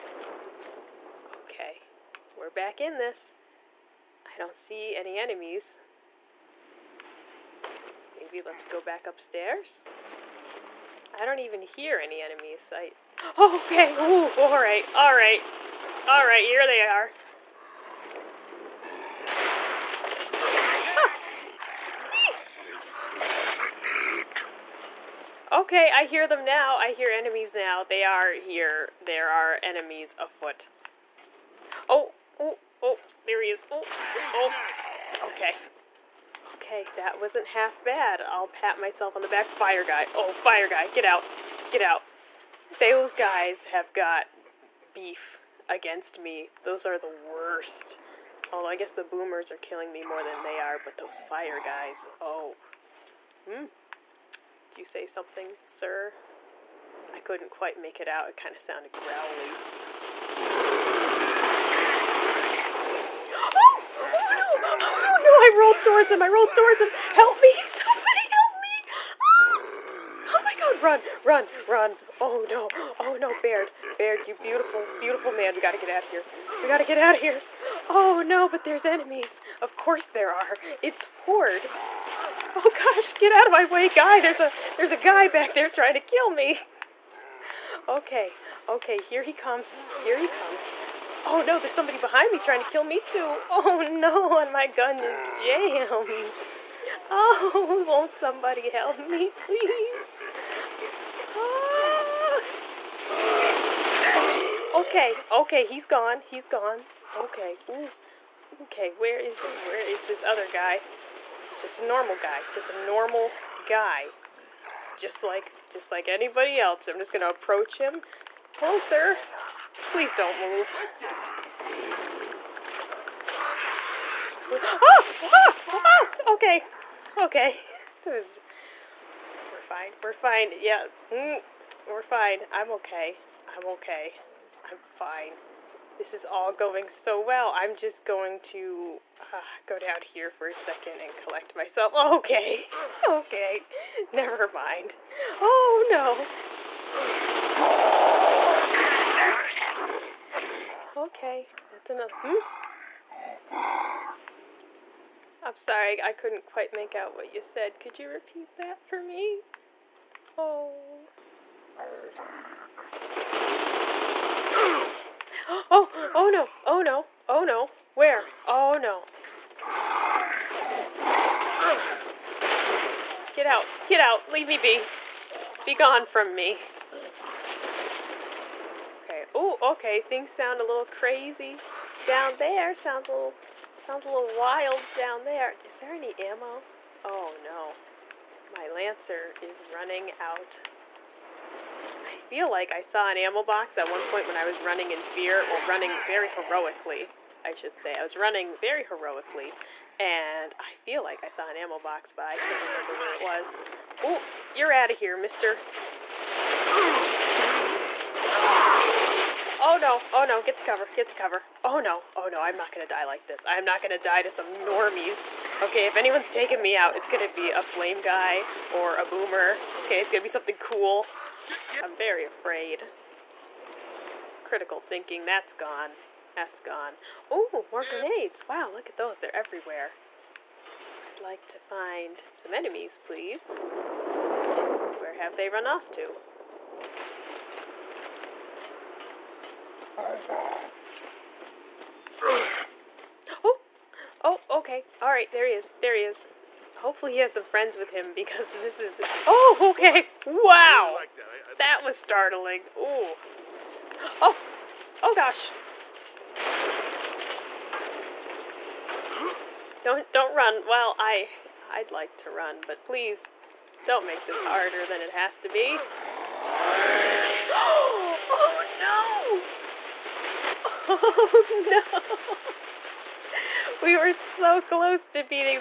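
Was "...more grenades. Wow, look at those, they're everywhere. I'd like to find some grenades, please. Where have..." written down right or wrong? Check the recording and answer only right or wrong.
wrong.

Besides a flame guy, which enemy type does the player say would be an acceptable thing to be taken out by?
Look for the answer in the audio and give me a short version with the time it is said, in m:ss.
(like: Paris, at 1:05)
boomer, at 3:39.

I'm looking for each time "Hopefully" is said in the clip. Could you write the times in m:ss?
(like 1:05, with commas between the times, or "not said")
4:06.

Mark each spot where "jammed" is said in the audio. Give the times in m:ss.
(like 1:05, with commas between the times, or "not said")
1:35.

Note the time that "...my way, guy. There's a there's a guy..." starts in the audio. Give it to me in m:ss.
1:23.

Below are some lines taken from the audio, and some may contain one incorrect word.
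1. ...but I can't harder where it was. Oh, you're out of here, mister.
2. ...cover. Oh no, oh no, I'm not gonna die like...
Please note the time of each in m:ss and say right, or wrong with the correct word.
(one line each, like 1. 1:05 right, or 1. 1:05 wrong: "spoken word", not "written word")
1. 3:22 wrong: "remember", not "harder"
2. 3:31 right.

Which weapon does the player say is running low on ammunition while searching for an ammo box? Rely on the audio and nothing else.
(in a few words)
Lancer.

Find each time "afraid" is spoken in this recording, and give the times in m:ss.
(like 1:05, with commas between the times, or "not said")
3:42.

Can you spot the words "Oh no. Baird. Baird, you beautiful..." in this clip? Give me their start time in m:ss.
1:12.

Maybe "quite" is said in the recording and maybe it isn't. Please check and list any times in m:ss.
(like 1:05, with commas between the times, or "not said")
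0:57, 2:36.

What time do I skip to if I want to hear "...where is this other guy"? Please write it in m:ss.
1:49.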